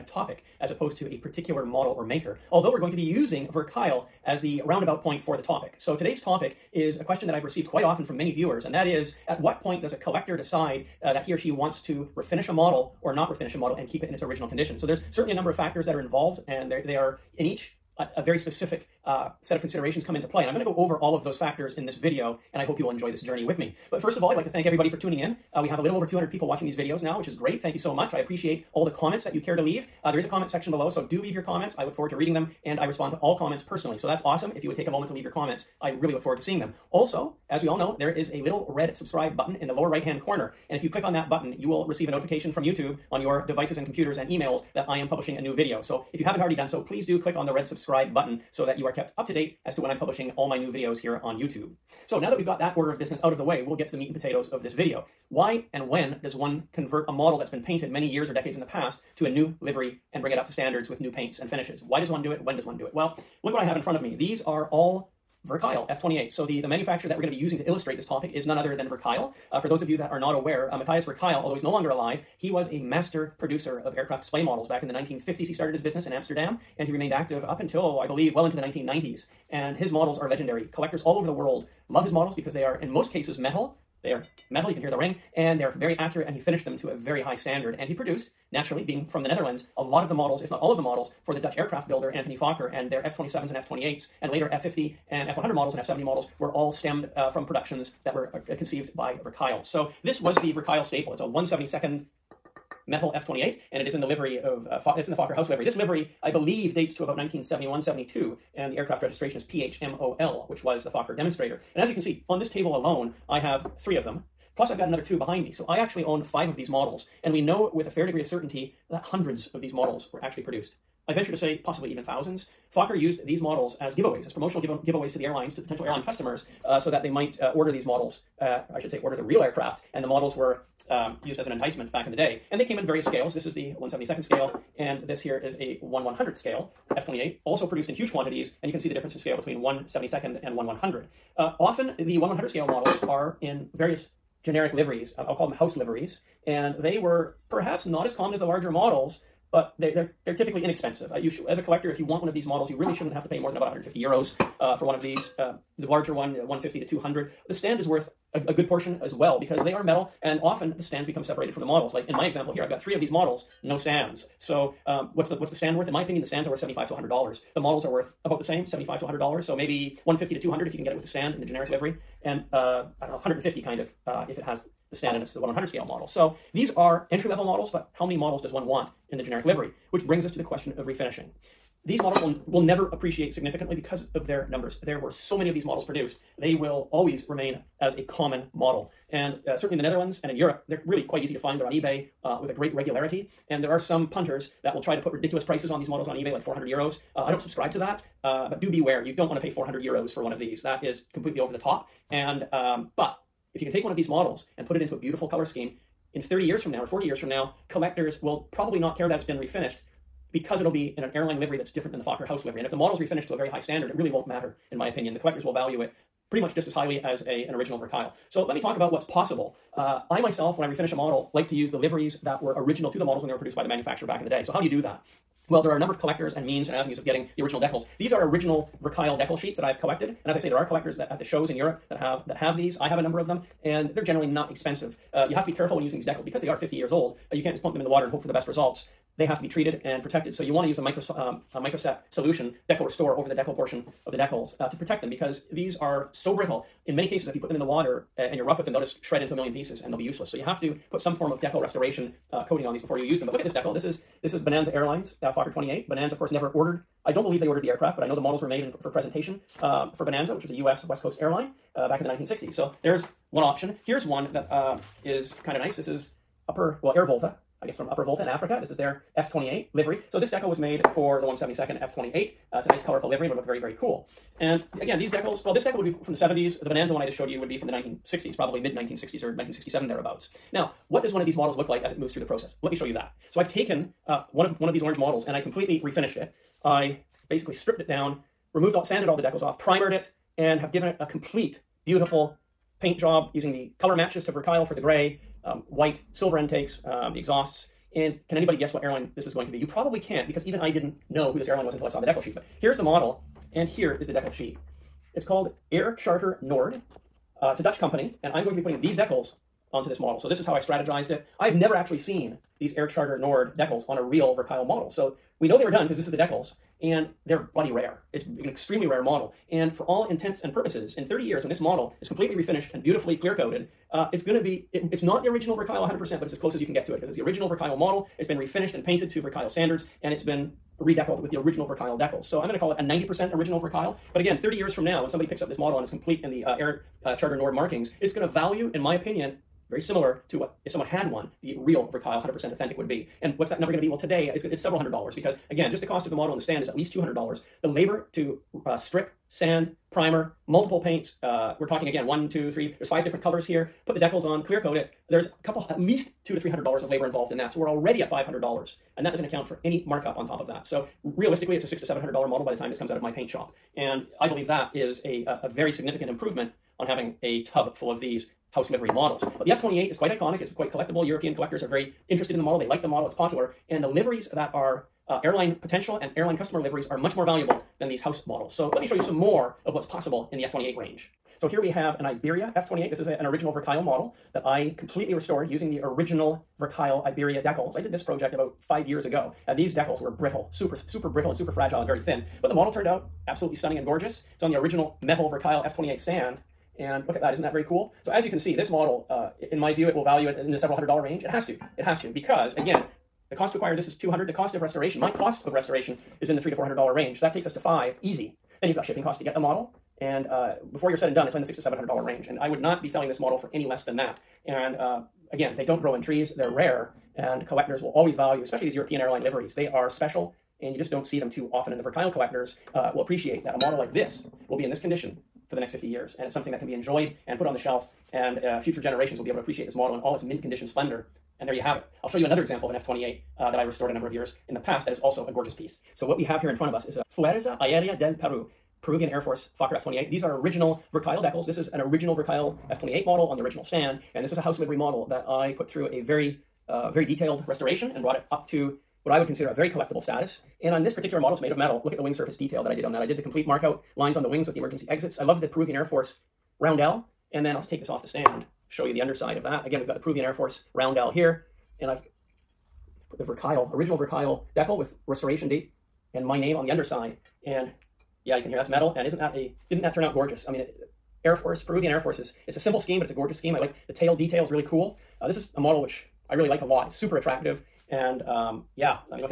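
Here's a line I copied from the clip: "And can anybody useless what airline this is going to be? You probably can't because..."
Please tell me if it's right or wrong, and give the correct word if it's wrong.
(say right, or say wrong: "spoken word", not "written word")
wrong: "guess", not "useless".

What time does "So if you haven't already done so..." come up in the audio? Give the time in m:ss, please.
0:45.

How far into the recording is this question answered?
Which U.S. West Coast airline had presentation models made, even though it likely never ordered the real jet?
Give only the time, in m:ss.
4:14.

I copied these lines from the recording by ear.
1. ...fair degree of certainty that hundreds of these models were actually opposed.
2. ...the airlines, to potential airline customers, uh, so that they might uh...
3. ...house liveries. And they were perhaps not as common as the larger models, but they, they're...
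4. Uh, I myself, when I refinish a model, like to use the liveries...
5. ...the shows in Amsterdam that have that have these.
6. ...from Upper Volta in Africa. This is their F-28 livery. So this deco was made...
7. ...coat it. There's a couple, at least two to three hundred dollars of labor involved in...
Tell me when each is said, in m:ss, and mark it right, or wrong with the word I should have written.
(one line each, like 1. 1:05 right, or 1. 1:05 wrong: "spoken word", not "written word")
1. 1:57 wrong: "produced", not "opposed"
2. 2:05 right
3. 2:25 right
4. 3:39 right
5. 3:51 wrong: "Europe", not "Amsterdam"
6. 4:27 right
7. 5:54 right.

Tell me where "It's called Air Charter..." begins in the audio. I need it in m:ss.
5:05.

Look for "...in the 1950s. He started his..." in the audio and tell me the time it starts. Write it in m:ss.
1:14.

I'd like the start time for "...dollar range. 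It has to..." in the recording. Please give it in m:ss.
6:40.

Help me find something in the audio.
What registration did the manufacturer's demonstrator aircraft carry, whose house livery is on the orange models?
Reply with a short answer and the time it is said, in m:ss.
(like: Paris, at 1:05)
PHMOL, at 1:49.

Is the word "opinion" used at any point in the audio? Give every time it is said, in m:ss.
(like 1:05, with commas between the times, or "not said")
2:46, 3:34, 5:38.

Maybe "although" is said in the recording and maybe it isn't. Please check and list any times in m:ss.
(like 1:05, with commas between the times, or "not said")
0:02, 1:11.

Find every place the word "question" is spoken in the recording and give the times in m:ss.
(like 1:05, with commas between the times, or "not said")
0:07, 3:00.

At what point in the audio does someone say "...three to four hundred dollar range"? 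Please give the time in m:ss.
6:46.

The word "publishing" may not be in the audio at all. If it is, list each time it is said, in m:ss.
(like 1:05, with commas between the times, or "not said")
0:45, 0:49.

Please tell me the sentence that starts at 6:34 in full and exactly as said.
It's on the original metal Verkuyl F28 stand.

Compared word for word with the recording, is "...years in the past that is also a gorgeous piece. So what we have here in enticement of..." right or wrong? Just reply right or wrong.
wrong.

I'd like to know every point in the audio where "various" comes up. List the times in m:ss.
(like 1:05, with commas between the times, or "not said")
2:12, 2:23.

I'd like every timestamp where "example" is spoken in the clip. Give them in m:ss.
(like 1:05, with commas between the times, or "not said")
2:42, 7:12.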